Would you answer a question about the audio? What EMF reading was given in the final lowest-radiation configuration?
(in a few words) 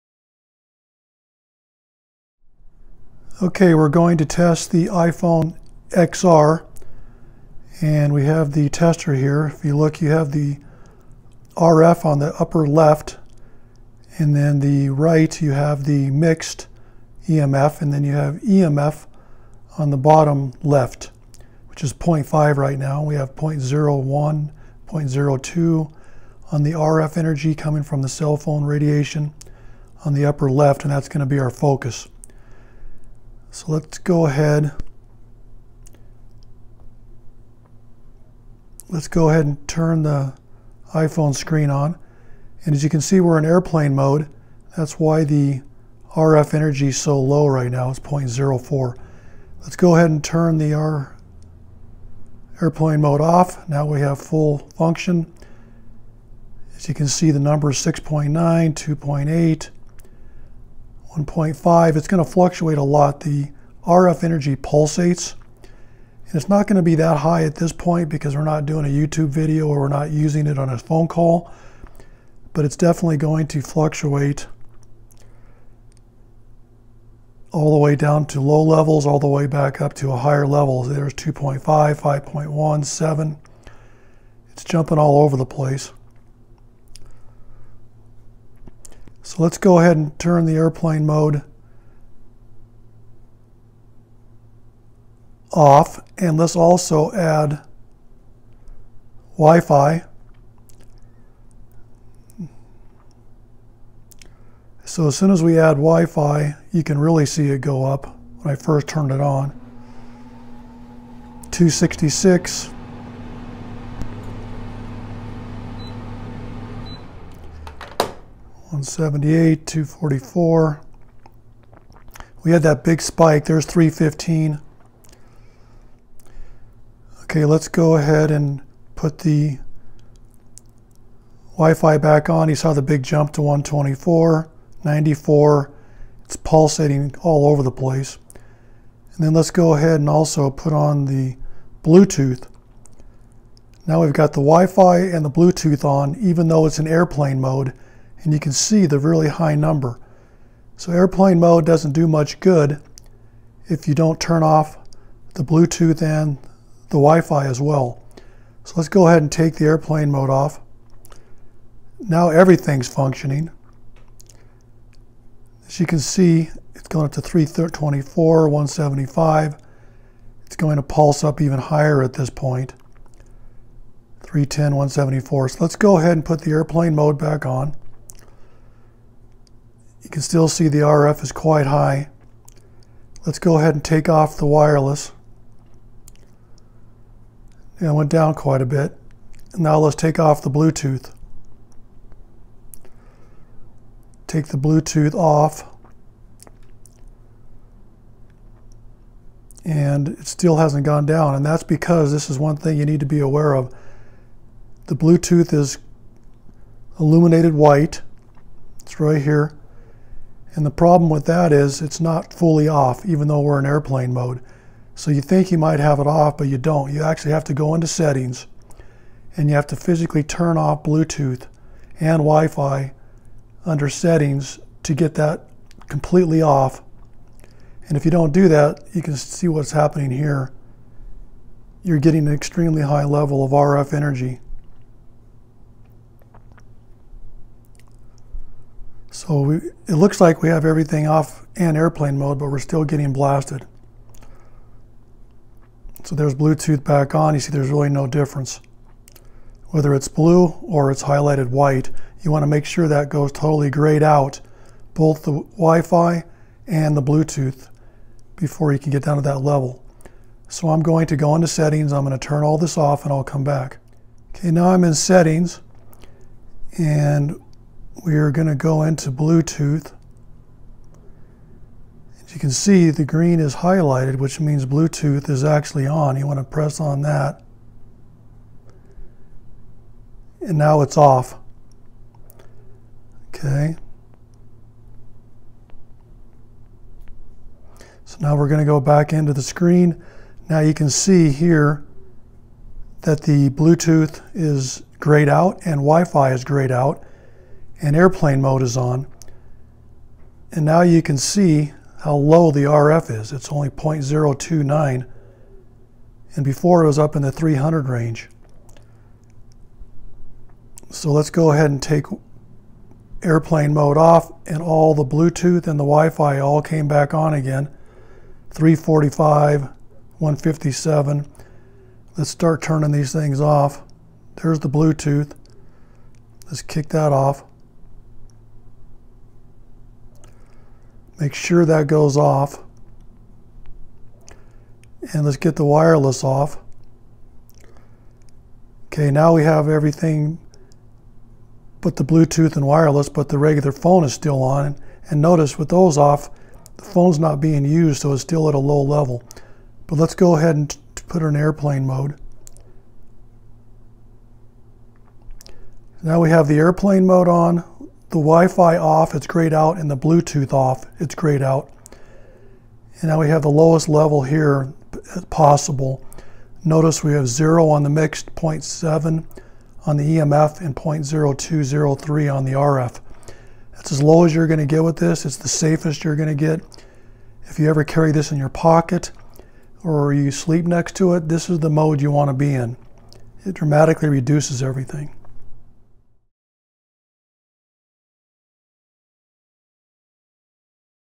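0.7.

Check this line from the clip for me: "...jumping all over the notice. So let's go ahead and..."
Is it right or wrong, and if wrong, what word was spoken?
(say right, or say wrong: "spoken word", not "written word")
wrong: "place", not "notice".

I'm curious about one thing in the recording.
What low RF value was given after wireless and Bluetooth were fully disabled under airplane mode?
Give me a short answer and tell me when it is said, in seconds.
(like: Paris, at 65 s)
0.029, at 303 s.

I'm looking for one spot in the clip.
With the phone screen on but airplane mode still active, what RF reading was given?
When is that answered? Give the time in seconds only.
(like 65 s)
47 s.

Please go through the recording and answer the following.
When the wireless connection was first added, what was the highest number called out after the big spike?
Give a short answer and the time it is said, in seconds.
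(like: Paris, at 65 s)
315, at 123 s.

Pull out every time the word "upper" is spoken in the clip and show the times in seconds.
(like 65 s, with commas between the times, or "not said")
12 s, 30 s.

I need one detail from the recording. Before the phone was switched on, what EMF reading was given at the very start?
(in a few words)
0.5.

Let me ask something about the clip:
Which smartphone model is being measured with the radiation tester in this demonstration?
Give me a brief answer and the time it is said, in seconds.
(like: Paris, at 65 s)
iPhone XR, at 4 s.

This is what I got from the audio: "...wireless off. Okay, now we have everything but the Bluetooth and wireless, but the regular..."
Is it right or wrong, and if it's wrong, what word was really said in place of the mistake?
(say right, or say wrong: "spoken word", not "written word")
right.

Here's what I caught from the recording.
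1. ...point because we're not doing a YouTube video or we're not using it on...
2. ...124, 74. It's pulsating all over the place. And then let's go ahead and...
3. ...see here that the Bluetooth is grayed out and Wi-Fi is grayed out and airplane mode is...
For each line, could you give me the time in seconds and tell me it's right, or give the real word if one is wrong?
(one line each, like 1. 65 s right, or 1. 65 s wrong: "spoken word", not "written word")
1. 67 s right
2. 133 s wrong: "94", not "74"
3. 290 s right.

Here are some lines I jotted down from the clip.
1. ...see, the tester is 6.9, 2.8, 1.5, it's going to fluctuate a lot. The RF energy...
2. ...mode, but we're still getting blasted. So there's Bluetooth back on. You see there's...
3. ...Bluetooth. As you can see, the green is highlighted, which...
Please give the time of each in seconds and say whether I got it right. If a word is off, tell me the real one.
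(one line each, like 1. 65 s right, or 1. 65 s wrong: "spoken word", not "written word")
1. 57 s wrong: "number", not "tester"
2. 242 s right
3. 269 s right.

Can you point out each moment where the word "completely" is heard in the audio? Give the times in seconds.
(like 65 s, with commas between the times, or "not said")
225 s.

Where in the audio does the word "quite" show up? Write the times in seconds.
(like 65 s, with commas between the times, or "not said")
181 s, 188 s.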